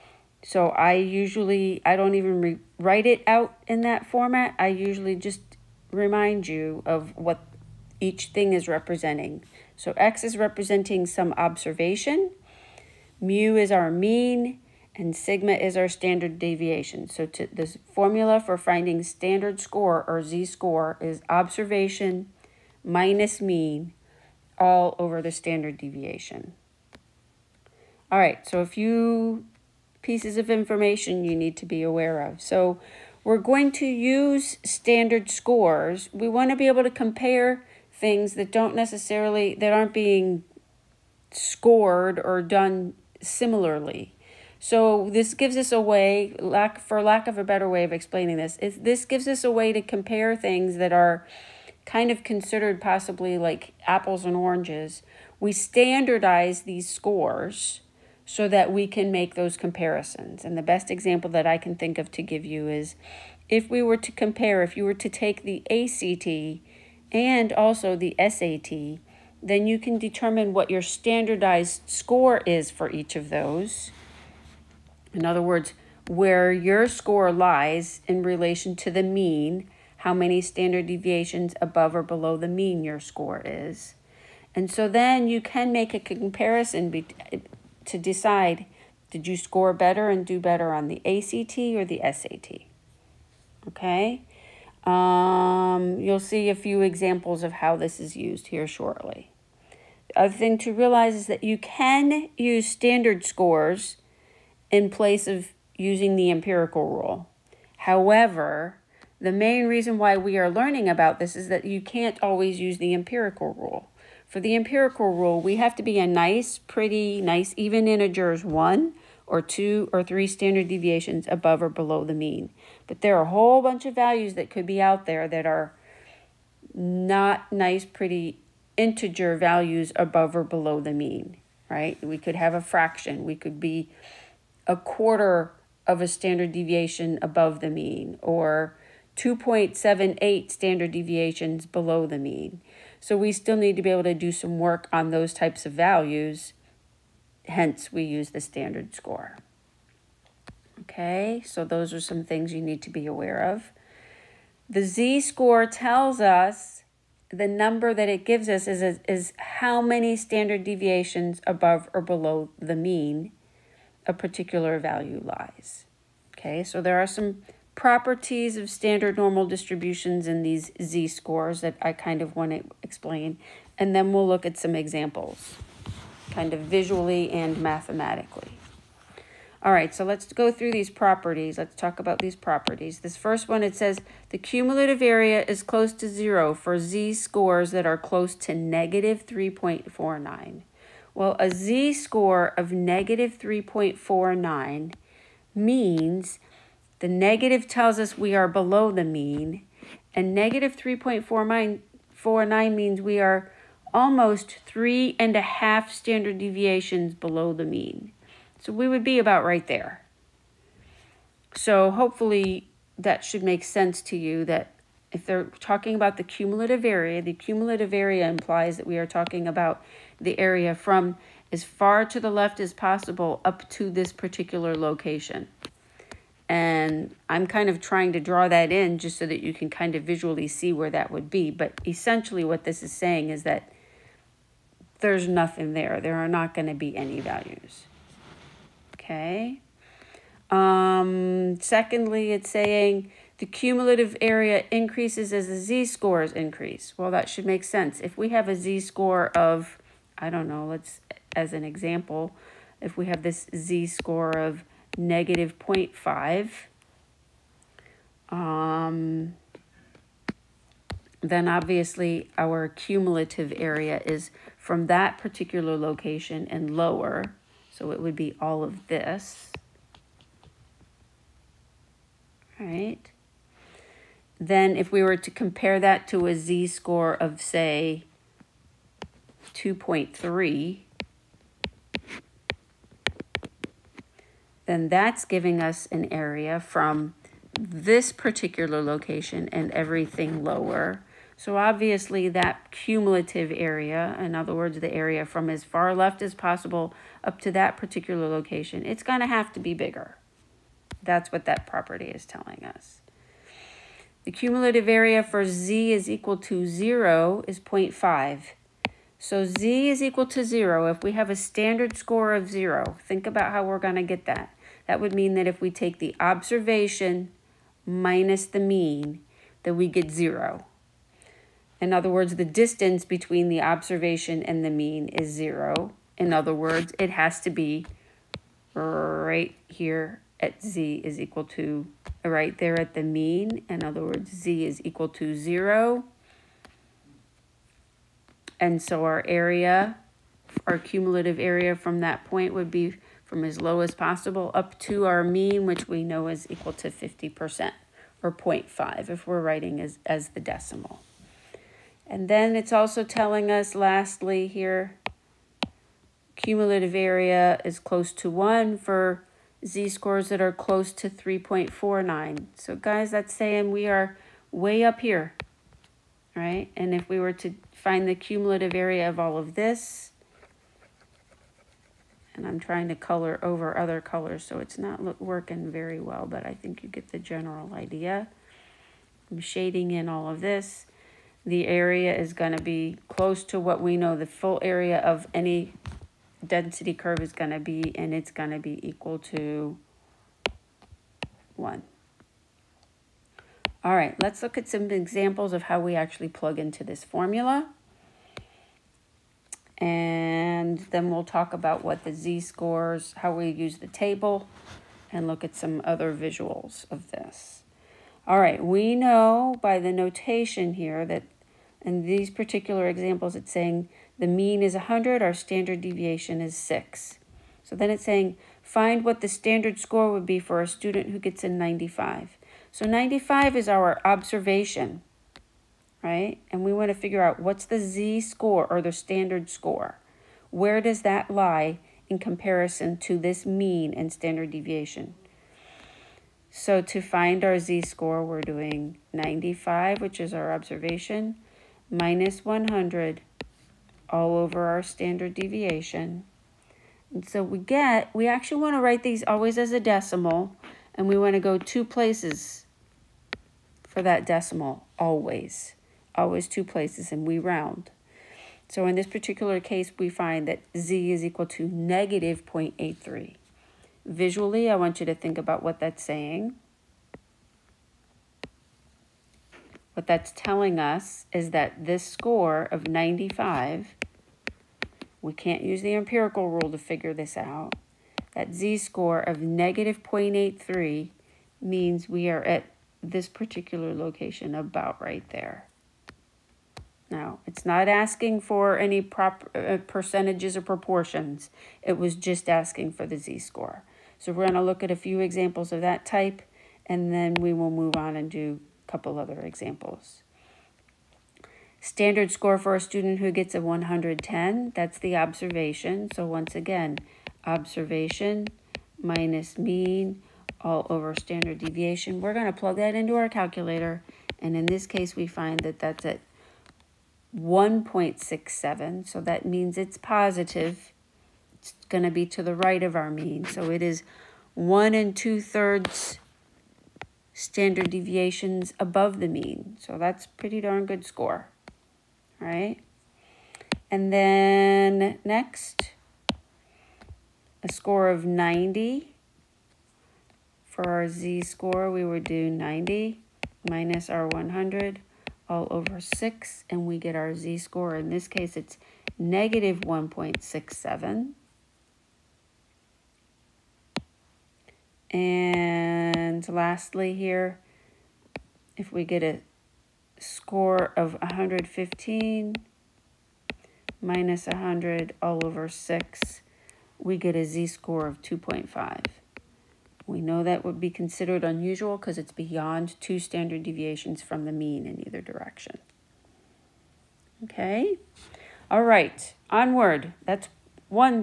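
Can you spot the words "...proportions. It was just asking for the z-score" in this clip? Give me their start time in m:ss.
8:10.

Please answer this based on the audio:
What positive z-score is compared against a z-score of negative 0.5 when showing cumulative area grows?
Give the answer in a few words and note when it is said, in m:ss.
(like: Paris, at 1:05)
2.3, at 4:39.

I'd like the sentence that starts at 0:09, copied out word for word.
So x is representing some observation, mu is our mean, and sigma is our standard deviation.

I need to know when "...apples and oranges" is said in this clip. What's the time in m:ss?
0:53.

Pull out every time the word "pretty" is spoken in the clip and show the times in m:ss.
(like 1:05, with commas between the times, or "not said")
1:56, 2:07, 8:50.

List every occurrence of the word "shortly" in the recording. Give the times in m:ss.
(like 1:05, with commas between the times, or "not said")
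1:38.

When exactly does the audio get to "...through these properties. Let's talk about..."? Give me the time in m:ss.
3:00.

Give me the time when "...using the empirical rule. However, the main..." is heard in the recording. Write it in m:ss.
1:45.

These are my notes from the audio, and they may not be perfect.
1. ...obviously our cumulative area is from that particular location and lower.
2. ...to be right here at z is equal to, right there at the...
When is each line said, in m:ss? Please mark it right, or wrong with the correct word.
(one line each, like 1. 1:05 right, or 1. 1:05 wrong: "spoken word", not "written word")
1. 4:21 right
2. 5:27 right.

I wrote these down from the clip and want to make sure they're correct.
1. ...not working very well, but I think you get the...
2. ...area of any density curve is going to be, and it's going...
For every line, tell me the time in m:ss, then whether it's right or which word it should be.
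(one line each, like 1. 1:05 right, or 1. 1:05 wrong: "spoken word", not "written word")
1. 6:14 right
2. 6:24 right.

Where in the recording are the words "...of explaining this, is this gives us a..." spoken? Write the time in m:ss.
0:47.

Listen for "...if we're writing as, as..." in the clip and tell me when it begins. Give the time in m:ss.
5:49.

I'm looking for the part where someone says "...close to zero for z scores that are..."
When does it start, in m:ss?
3:05.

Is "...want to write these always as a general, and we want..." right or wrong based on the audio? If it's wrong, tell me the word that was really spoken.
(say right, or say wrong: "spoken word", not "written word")
wrong: "decimal", not "general".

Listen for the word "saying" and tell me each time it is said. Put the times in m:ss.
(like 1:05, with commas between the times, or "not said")
3:52, 4:02, 6:03, 6:53, 6:58, 7:46.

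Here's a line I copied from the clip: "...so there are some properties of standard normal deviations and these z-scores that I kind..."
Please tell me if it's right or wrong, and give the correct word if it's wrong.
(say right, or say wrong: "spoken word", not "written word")
wrong: "distributions", not "deviations".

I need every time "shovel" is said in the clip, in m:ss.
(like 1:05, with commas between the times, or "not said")
not said.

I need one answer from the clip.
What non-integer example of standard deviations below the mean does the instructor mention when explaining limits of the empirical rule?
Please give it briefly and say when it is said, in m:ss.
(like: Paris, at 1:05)
2.78, at 2:19.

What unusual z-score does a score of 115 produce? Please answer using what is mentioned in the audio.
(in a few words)
2.5.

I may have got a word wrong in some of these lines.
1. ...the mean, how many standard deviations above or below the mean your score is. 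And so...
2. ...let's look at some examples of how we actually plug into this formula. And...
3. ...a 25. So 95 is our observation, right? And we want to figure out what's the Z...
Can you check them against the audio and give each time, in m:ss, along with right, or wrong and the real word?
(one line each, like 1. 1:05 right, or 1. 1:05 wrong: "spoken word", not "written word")
1. 1:18 right
2. 6:34 right
3. 7:01 wrong: "95", not "25".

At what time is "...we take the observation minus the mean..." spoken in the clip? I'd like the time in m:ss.
5:15.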